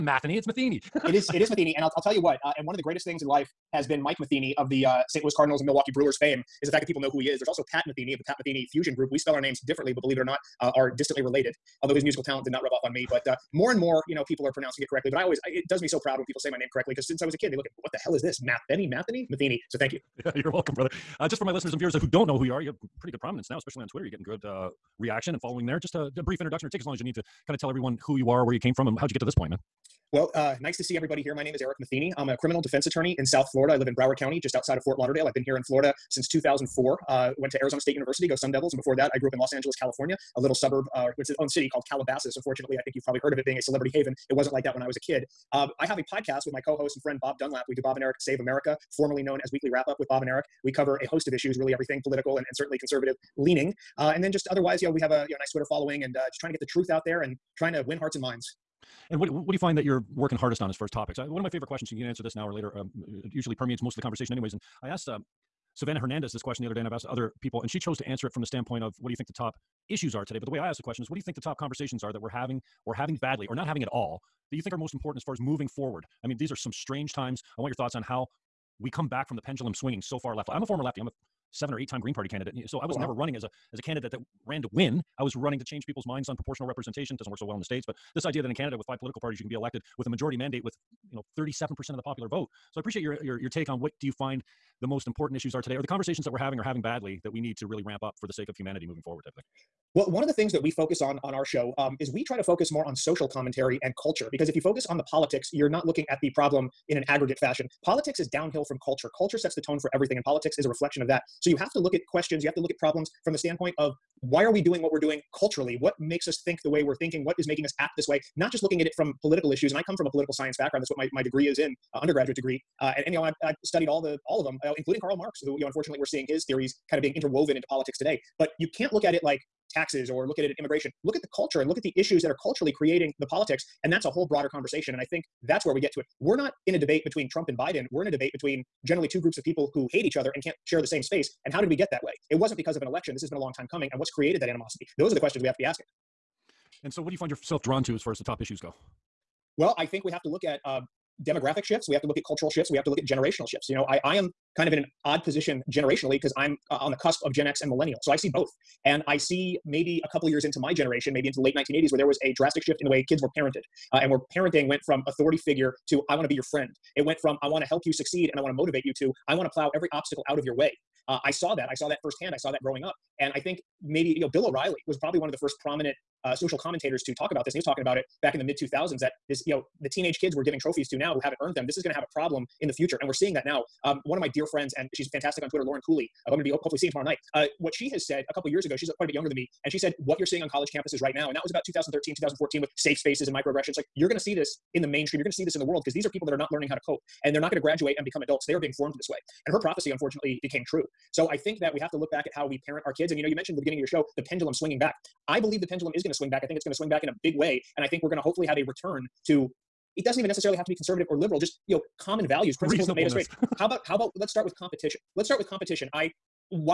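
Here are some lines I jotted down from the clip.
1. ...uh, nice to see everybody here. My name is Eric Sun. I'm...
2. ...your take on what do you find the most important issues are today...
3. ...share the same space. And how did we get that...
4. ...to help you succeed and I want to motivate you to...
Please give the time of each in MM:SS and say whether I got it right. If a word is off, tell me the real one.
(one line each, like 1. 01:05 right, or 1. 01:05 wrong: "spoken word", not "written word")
1. 00:30 wrong: "Matheny", not "Sun"
2. 01:33 right
3. 02:20 right
4. 02:47 right.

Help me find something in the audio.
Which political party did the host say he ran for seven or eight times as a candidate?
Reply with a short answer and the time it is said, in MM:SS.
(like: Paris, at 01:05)
Green Party, at 01:21.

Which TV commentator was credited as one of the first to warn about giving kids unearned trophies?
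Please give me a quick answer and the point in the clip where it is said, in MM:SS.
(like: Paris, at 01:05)
Bill O'Reilly, at 02:54.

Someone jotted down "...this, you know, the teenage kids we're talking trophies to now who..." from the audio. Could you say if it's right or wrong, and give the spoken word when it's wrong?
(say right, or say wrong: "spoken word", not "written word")
wrong: "giving", not "talking".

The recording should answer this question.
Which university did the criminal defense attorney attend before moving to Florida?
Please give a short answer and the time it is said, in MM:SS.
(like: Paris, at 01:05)
Arizona State University, at 00:37.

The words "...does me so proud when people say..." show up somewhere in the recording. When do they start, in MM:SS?
00:15.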